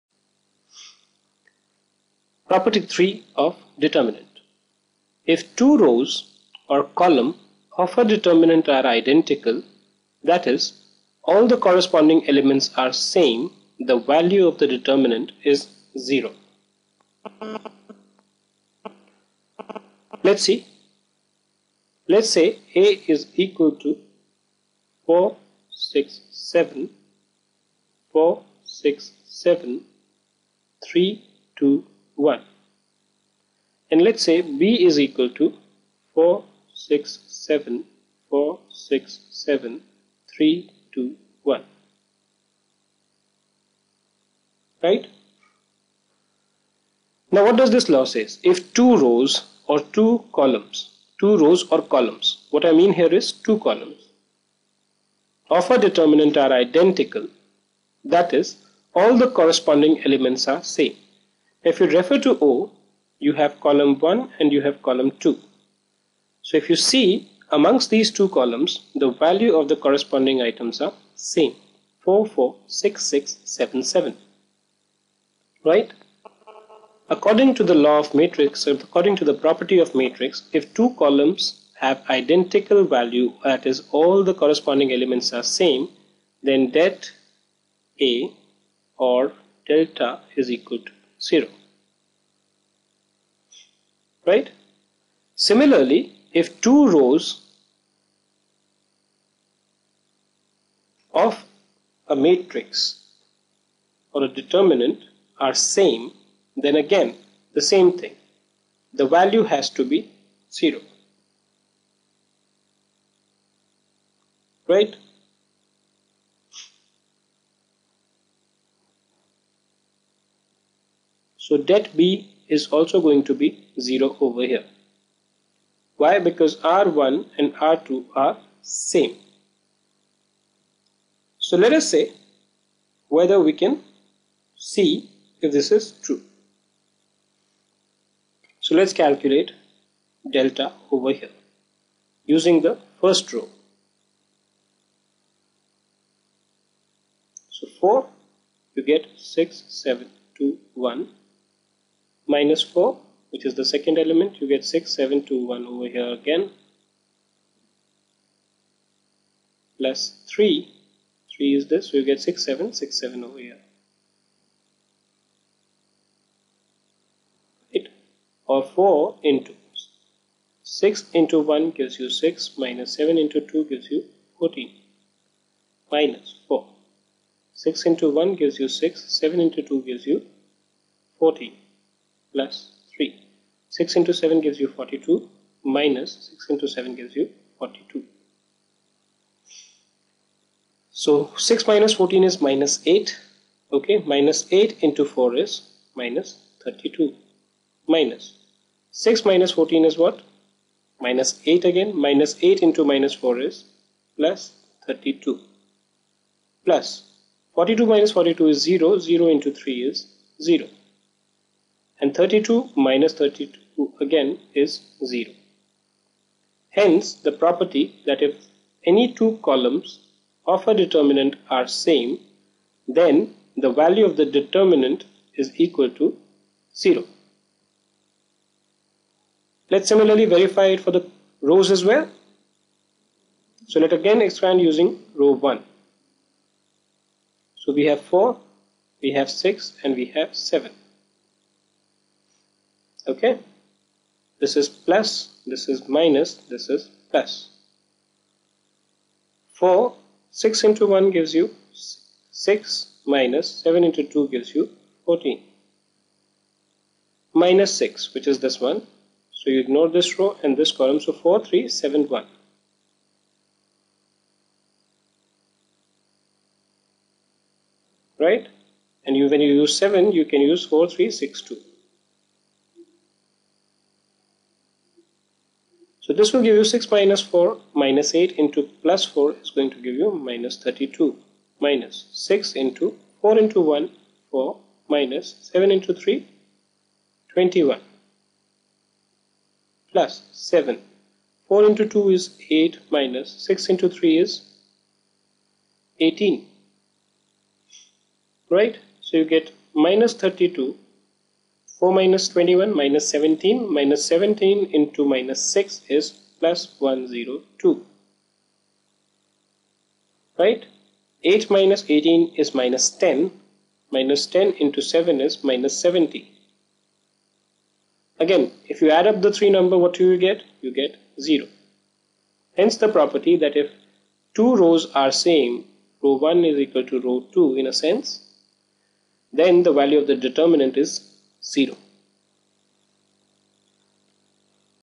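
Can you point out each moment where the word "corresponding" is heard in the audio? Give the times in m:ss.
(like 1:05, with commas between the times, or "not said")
0:11, 0:59, 1:09, 1:24.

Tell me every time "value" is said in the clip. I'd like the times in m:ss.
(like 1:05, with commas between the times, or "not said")
0:13, 1:09, 1:22, 1:49, 3:43, 5:29.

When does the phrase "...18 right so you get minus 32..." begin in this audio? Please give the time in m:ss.
4:55.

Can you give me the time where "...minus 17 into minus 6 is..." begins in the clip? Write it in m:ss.
5:03.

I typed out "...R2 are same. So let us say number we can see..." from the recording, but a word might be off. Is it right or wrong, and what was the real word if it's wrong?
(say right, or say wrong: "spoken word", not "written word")
wrong: "whether", not "number".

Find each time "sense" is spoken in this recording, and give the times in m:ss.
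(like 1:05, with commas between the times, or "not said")
5:27.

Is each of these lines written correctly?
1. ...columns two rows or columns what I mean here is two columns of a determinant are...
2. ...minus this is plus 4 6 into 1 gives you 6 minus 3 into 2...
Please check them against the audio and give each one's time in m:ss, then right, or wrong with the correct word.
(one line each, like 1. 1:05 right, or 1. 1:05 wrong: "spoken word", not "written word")
1. 0:50 right
2. 4:05 wrong: "7", not "3".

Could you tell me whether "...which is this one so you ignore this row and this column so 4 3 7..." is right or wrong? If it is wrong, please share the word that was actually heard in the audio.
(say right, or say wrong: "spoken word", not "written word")
right.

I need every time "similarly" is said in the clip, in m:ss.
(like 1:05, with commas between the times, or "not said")
1:35, 3:49.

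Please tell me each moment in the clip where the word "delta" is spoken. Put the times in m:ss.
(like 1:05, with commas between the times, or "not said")
1:29, 2:20.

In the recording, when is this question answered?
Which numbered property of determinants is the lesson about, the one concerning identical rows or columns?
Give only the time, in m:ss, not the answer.
0:02.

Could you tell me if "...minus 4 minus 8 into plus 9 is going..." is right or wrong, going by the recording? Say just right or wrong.
wrong.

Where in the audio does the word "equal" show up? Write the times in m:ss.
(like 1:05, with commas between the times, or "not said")
0:23, 0:35, 1:30, 3:45, 5:26.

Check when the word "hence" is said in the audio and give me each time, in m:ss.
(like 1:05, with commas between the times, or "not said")
3:36, 5:22.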